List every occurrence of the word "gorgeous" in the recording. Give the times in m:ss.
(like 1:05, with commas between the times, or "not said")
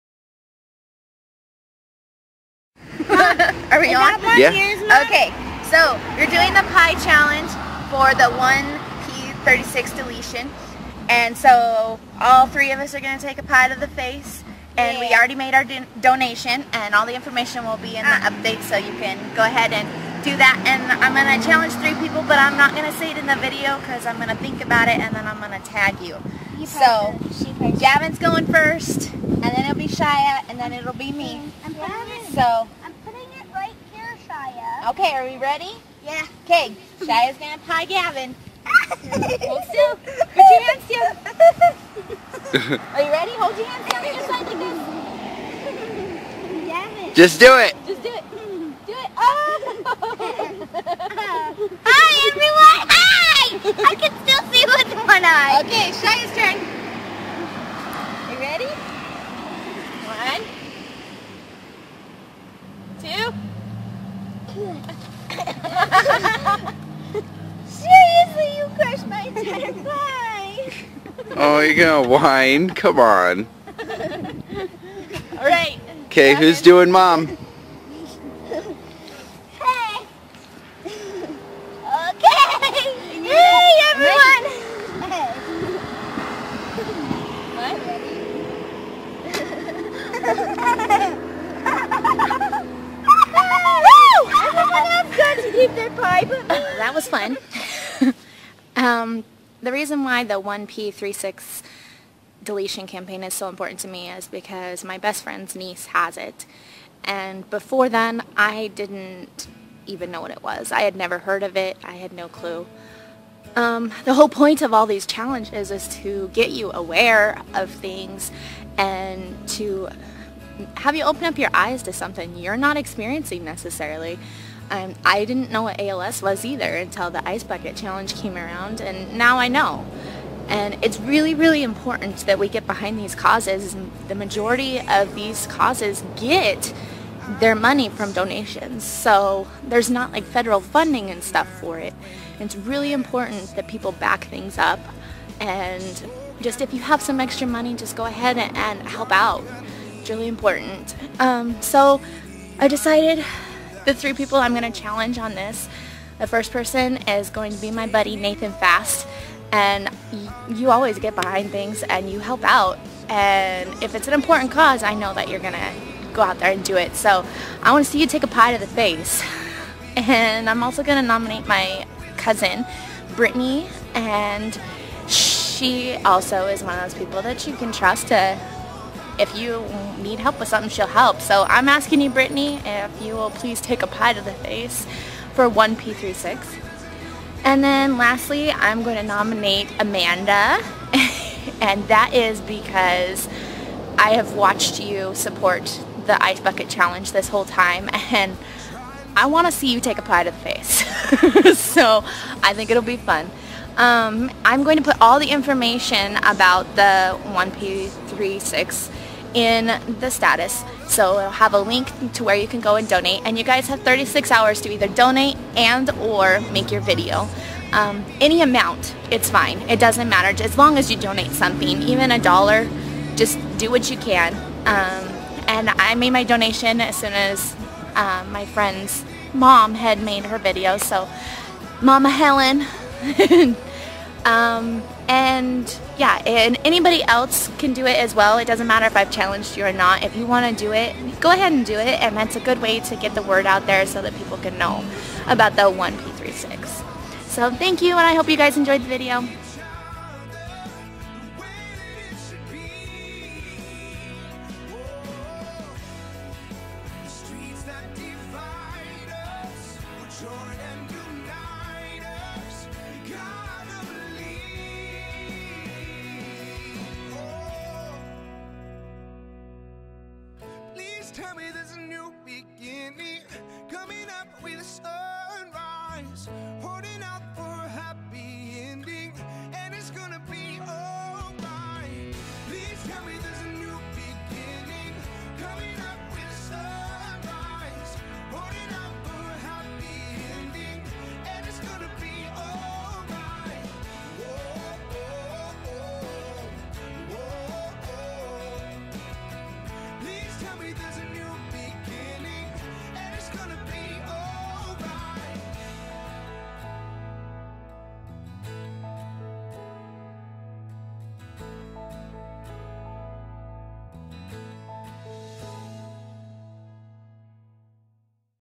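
not said.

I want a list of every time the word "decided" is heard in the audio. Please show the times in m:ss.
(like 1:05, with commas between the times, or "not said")
2:32.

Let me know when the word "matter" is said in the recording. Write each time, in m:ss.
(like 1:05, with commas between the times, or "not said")
3:40, 3:58.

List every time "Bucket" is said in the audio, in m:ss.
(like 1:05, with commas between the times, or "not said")
2:07, 3:16.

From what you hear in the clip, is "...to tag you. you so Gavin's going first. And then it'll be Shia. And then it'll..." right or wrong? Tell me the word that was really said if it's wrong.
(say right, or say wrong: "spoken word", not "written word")
right.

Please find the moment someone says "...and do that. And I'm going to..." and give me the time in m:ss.
0:19.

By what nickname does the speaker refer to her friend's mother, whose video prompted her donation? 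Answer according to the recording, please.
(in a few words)
Mama Helen.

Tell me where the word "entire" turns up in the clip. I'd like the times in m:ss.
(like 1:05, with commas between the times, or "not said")
1:09.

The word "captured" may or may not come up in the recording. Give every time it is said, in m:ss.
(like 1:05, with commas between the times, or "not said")
not said.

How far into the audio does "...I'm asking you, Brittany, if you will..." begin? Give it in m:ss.
3:01.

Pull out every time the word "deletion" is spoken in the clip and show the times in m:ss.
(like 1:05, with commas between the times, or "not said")
0:09, 1:42.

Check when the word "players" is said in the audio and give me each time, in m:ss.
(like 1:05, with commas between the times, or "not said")
not said.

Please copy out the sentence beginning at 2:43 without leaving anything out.
And if it's an important cause, I know that you're going to go out there and do it.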